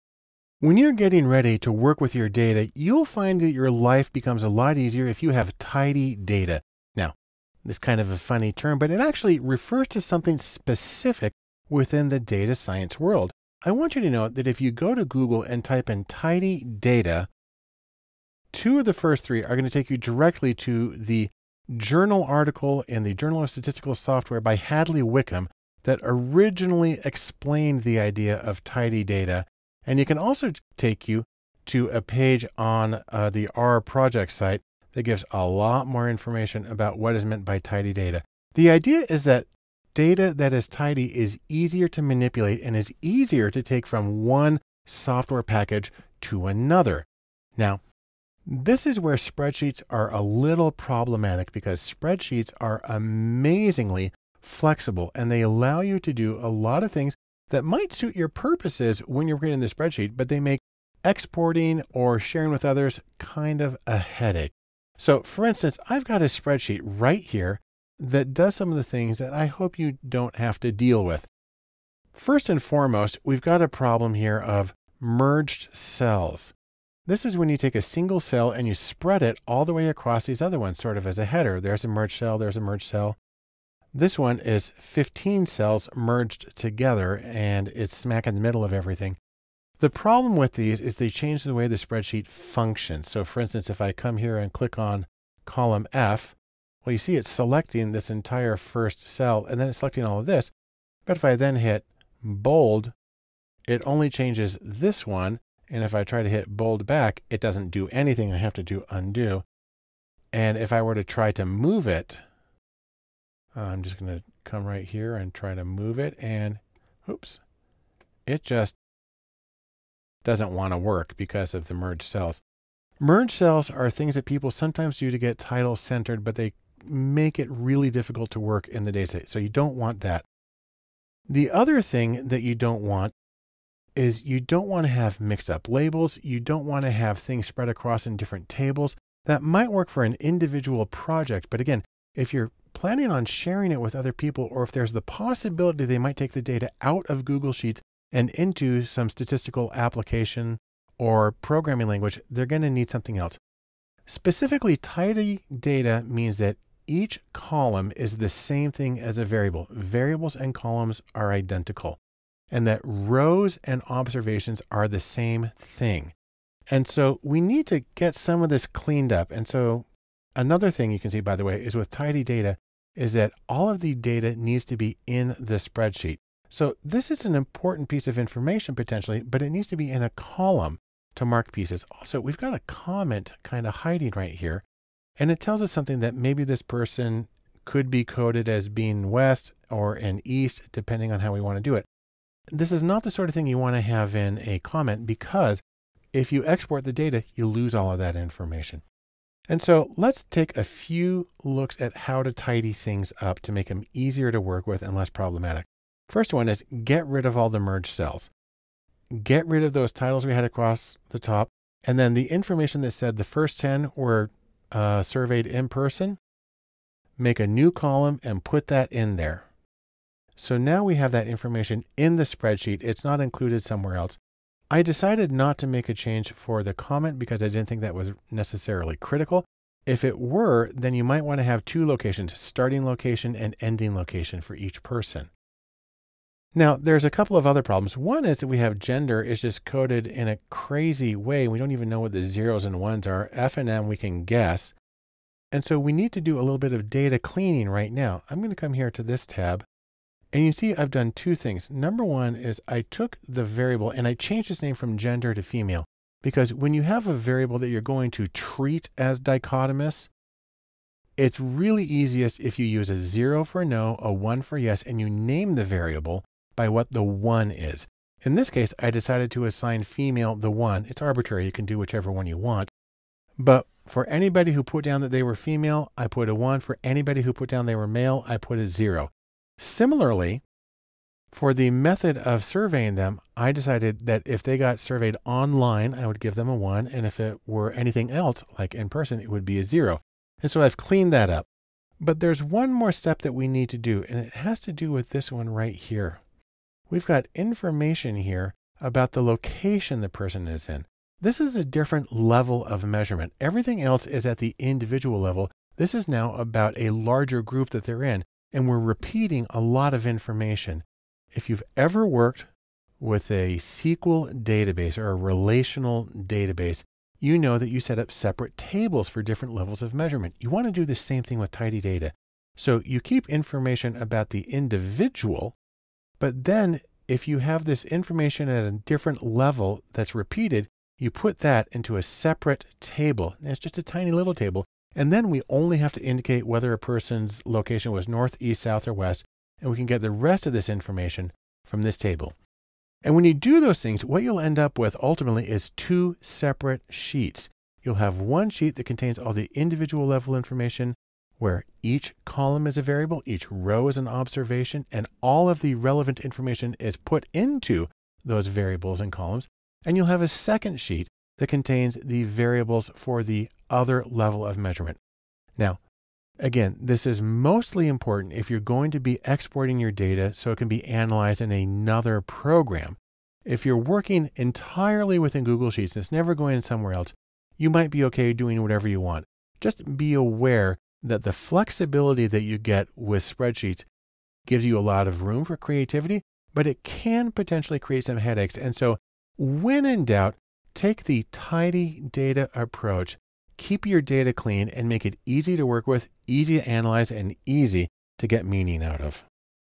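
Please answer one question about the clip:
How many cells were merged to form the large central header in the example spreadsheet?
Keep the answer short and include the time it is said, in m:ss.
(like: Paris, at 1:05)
15, at 1:24.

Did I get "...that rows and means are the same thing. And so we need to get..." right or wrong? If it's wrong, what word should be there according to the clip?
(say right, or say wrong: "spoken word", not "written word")
wrong: "observations", not "means".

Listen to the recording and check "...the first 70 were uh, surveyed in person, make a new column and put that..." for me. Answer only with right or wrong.
wrong.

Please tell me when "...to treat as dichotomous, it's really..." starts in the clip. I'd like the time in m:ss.
4:18.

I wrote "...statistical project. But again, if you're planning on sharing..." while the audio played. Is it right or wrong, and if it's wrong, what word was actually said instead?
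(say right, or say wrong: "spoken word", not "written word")
wrong: "individual", not "statistical".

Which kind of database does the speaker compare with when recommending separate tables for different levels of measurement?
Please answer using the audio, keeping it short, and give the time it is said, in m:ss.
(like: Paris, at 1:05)
SQL database, at 5:13.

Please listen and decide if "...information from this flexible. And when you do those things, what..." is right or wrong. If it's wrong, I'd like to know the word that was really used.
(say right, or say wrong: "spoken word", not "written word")
wrong: "table", not "flexible".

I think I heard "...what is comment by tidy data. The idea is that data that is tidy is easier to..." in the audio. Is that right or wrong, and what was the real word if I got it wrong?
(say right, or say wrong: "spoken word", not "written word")
wrong: "meant", not "comment".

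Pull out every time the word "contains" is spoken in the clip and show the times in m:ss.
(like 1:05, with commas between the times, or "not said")
5:48, 6:01.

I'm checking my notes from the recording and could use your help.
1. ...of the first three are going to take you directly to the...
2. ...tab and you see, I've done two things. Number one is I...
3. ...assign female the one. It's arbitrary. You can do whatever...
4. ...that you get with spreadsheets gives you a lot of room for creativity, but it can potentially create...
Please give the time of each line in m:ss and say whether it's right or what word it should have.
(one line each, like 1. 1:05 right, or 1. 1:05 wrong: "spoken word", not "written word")
1. 0:18 right
2. 4:09 right
3. 4:29 wrong: "whichever", not "whatever"
4. 6:22 right.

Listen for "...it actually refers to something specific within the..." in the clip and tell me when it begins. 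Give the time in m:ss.
0:08.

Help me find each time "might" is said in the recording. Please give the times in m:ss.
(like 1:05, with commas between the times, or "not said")
0:57, 2:19, 2:25, 3:51, 6:17.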